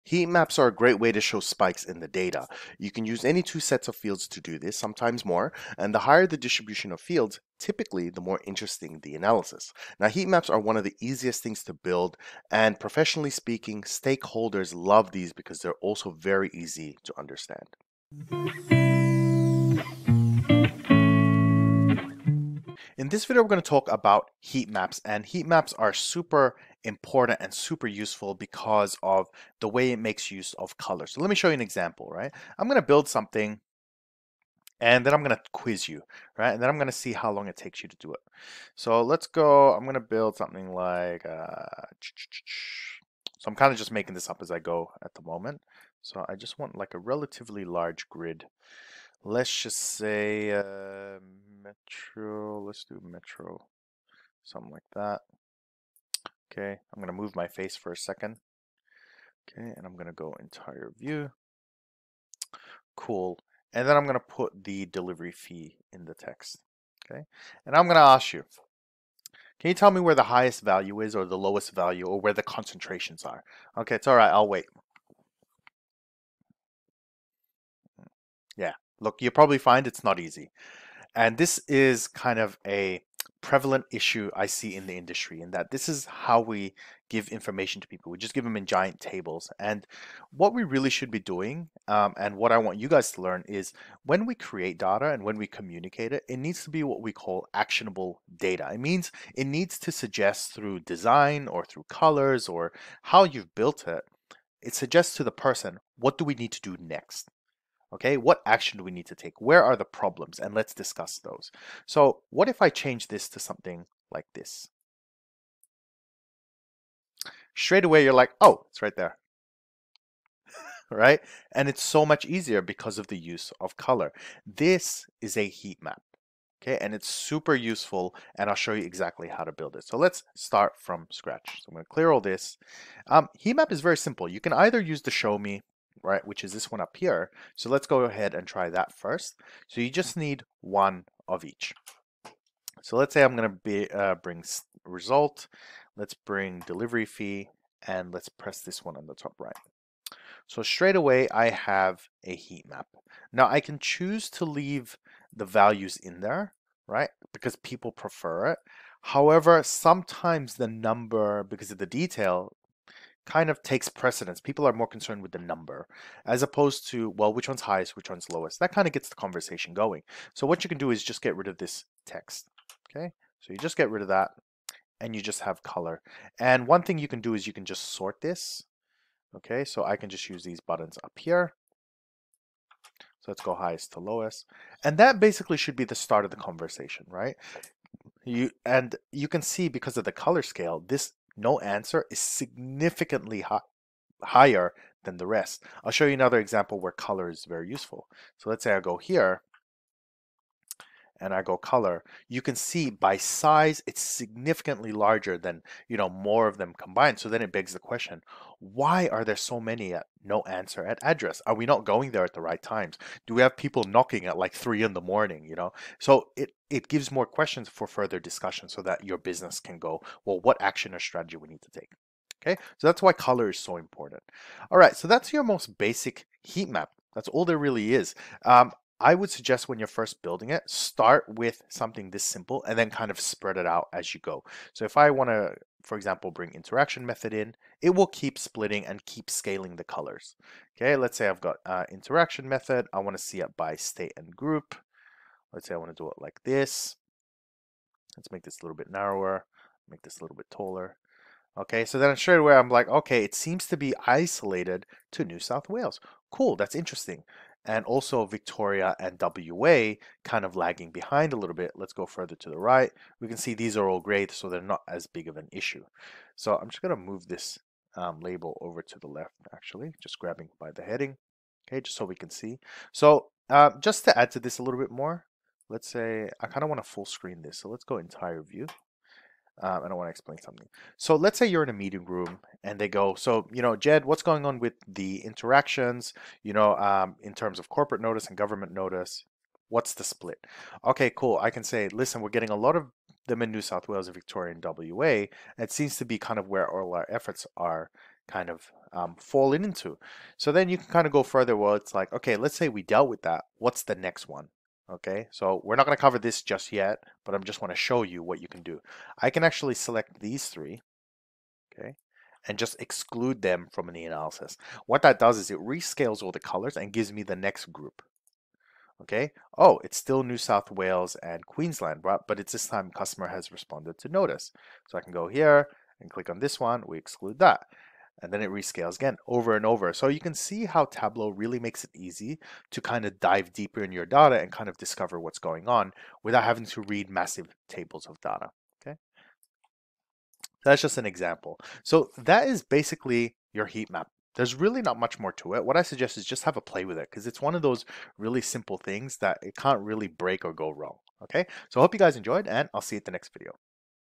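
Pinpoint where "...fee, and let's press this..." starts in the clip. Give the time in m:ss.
2:27.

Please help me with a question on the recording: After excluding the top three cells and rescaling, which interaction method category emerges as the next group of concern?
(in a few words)
Customer has responded to notice.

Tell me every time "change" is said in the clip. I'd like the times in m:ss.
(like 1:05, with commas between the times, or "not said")
1:52.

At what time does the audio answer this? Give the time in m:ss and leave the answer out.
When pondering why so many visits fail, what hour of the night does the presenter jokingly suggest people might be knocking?
3:34.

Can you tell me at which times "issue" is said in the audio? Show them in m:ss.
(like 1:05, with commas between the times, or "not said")
1:23, 4:25.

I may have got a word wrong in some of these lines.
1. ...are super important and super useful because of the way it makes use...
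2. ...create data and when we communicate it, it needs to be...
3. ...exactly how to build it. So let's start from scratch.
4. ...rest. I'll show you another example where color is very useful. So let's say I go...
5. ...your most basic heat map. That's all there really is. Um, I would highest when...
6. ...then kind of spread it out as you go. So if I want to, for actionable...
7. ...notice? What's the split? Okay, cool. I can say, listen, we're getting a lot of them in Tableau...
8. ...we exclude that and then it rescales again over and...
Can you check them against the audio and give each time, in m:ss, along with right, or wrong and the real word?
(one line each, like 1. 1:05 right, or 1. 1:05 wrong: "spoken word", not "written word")
1. 0:25 right
2. 1:34 right
3. 2:08 right
4. 3:15 right
5. 3:45 wrong: "suggest", not "highest"
6. 3:52 wrong: "example", not "actionable"
7. 4:48 wrong: "New", not "Tableau"
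8. 5:26 right.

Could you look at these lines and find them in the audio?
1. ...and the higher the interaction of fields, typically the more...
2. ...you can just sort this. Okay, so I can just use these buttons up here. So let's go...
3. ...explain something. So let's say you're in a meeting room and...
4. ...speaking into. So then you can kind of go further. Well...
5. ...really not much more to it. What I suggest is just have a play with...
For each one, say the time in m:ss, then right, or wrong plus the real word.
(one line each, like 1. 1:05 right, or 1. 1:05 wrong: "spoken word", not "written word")
1. 0:05 wrong: "distribution", not "interaction"
2. 2:57 right
3. 4:40 right
4. 4:59 wrong: "falling", not "speaking"
5. 5:44 right.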